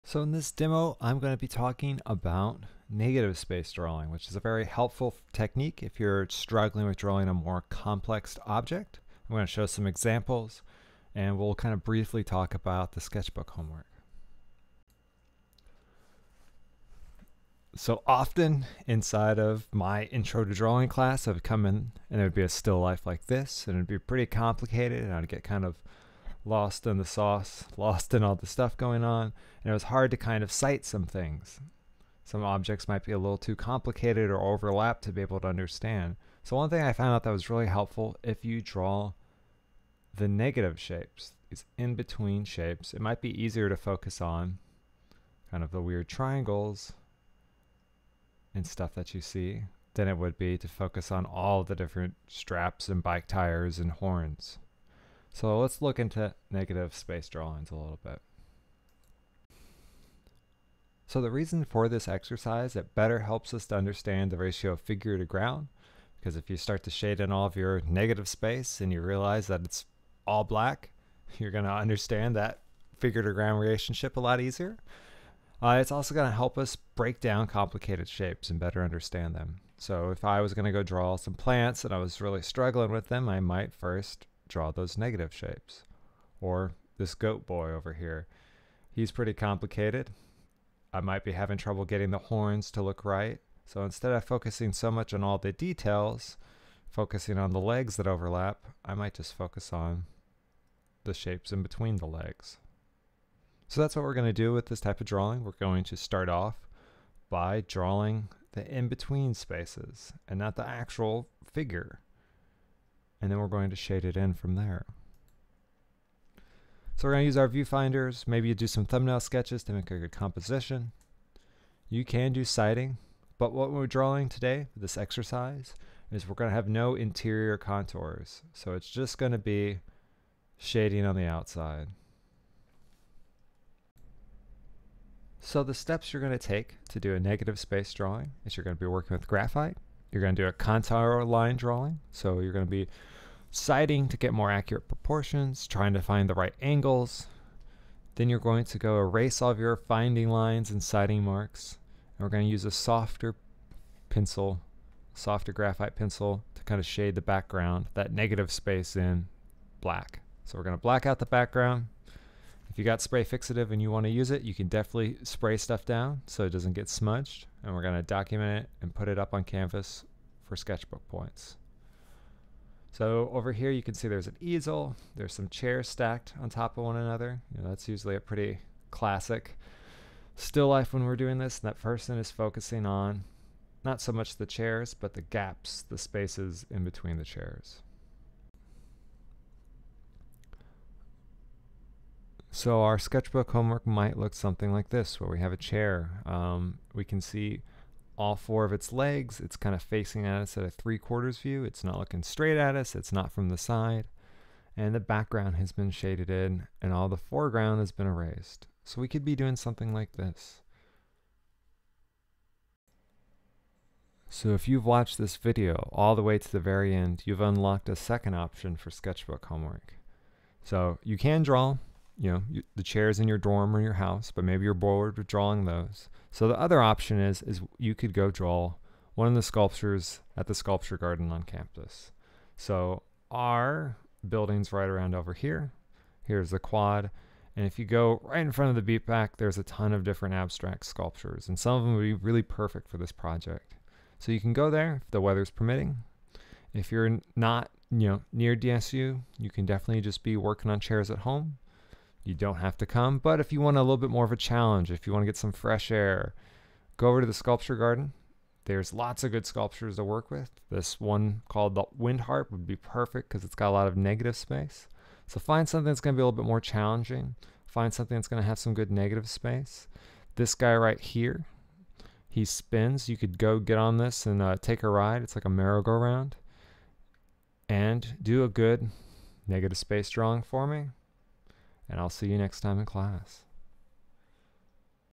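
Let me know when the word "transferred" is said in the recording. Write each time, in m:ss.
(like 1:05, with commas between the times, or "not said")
not said.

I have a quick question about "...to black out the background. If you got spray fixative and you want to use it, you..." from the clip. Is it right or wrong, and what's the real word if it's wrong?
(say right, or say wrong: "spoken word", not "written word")
right.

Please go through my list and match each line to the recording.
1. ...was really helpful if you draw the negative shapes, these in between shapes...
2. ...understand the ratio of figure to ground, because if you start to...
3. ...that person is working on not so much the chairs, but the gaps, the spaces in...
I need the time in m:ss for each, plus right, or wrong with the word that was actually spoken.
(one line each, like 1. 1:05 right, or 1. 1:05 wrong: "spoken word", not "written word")
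1. 0:37 right
2. 1:03 right
3. 3:01 wrong: "focusing", not "working".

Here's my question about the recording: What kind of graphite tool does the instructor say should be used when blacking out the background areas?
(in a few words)
softer graphite pencil.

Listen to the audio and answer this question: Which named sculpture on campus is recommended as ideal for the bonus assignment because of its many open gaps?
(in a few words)
the Wind Harp.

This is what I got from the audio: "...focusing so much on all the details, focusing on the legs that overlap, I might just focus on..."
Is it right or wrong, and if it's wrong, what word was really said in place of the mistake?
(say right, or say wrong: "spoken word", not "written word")
right.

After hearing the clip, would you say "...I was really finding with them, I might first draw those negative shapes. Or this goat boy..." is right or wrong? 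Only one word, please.
wrong.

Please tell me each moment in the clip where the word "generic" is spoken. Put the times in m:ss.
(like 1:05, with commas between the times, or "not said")
not said.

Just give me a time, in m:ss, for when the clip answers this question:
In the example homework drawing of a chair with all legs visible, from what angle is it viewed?
3:20.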